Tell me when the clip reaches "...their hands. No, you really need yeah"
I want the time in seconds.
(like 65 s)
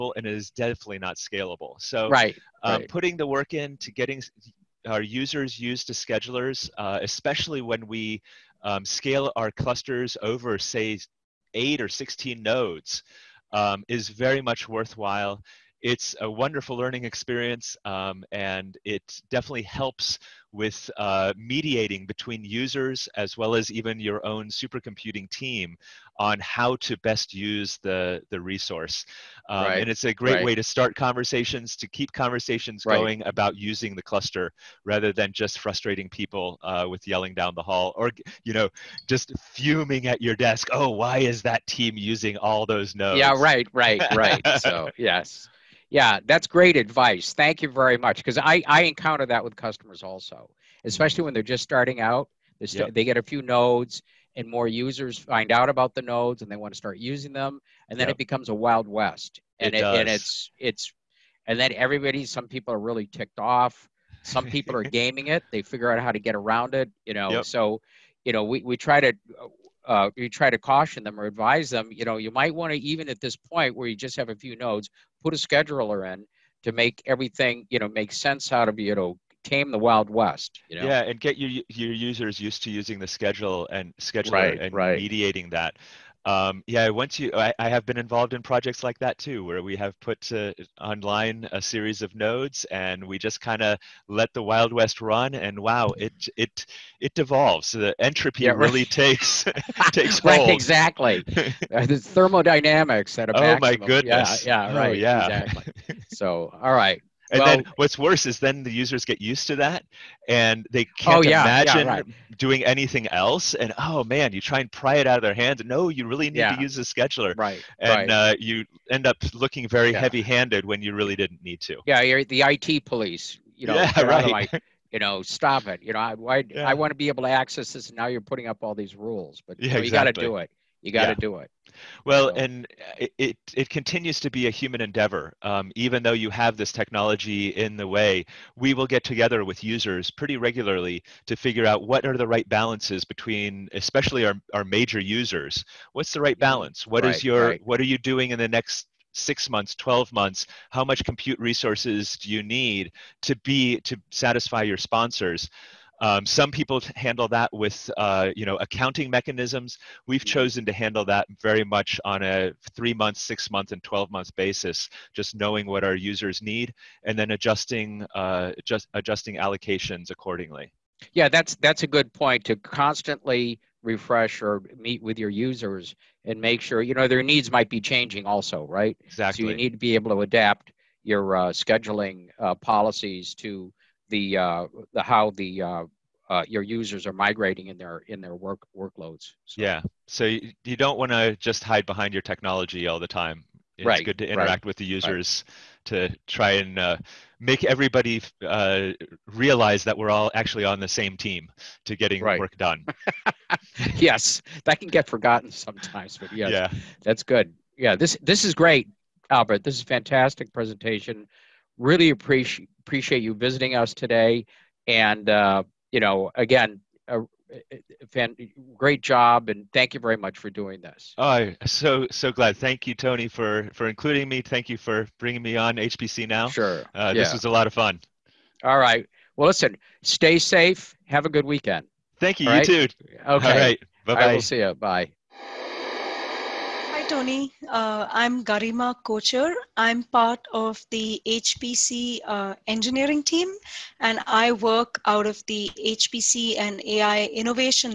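115 s.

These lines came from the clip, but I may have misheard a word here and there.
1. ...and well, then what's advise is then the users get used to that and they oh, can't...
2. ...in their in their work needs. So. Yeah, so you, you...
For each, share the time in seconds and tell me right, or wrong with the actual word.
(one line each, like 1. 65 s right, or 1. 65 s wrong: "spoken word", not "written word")
1. 107 s wrong: "worse", not "advise"
2. 187 s wrong: "workloads", not "needs".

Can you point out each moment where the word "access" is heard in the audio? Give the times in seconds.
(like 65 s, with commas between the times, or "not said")
127 s.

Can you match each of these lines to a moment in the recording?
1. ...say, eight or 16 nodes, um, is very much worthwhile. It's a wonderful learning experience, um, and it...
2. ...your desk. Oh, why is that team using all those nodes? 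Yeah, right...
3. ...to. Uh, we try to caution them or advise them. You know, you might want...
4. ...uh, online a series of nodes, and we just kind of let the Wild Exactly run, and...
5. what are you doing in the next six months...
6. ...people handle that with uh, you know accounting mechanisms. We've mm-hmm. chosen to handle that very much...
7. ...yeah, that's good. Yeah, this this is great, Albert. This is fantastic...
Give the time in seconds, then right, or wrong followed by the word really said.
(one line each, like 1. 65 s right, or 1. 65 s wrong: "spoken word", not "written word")
1. 10 s right
2. 40 s right
3. 69 s right
4. 90 s wrong: "West", not "Exactly"
5. 147 s right
6. 156 s right
7. 206 s right.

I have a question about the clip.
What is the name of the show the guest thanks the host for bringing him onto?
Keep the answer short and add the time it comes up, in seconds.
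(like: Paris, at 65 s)
HPC now, at 225 s.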